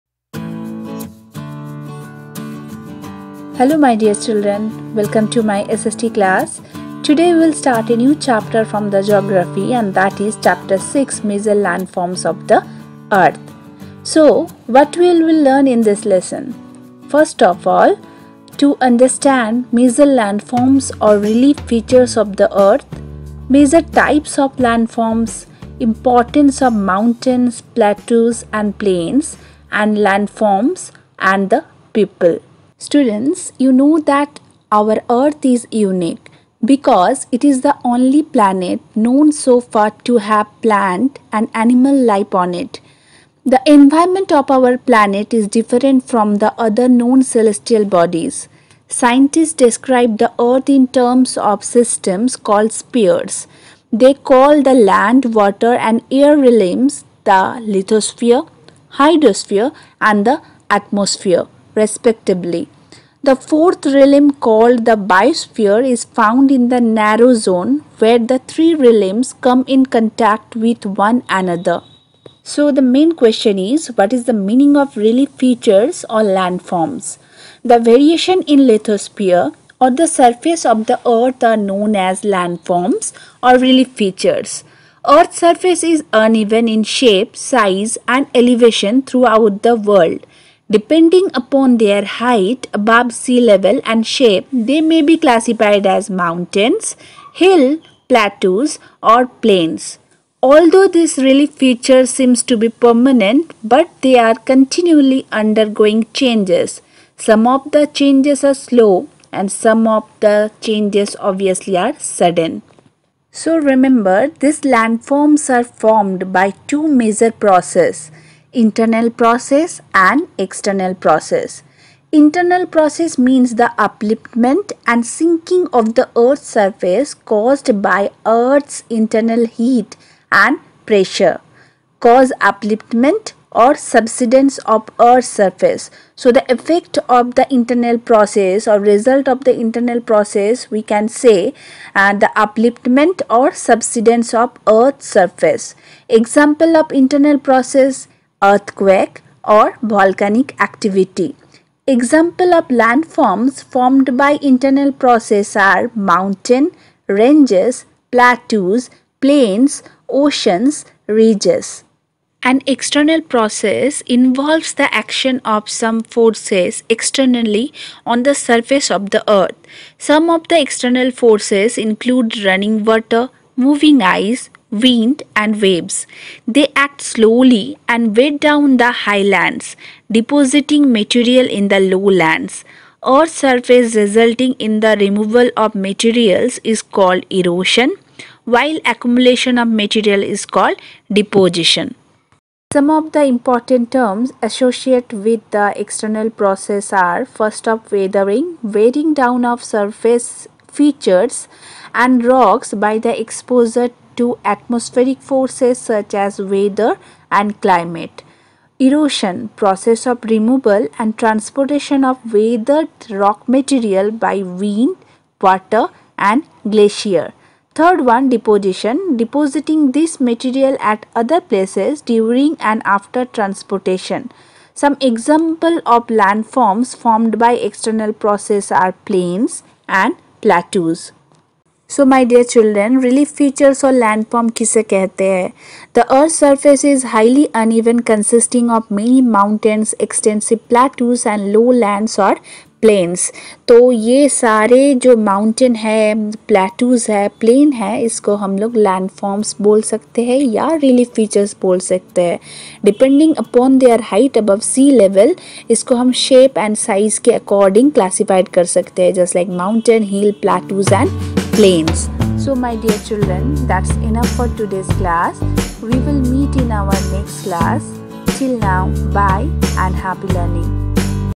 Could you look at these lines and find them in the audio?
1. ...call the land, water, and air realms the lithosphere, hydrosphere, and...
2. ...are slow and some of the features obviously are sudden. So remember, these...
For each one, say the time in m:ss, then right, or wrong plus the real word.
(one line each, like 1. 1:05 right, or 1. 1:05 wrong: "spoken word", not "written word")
1. 0:54 right
2. 1:48 wrong: "changes", not "features".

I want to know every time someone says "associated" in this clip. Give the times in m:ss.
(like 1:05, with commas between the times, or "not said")
3:14.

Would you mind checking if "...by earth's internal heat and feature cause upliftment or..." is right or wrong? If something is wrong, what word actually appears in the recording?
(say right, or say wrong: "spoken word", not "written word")
wrong: "pressure", not "feature".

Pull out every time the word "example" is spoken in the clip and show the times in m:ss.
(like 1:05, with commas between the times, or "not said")
2:26, 2:31, 3:45.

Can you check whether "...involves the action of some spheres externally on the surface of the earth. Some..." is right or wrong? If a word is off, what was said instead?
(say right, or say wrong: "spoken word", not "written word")
wrong: "forces", not "spheres".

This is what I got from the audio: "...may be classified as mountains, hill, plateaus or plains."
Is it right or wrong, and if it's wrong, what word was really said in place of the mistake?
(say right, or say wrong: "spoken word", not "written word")
right.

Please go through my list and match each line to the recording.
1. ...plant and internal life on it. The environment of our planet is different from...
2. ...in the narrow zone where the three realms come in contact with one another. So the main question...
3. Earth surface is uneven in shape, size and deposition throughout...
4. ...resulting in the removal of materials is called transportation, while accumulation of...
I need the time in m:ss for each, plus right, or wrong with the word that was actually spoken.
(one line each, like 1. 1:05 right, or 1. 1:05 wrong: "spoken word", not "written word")
1. 0:40 wrong: "animal", not "internal"
2. 1:06 right
3. 1:25 wrong: "elevation", not "deposition"
4. 3:03 wrong: "erosion", not "transportation".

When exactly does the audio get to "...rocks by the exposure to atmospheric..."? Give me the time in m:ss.
3:22.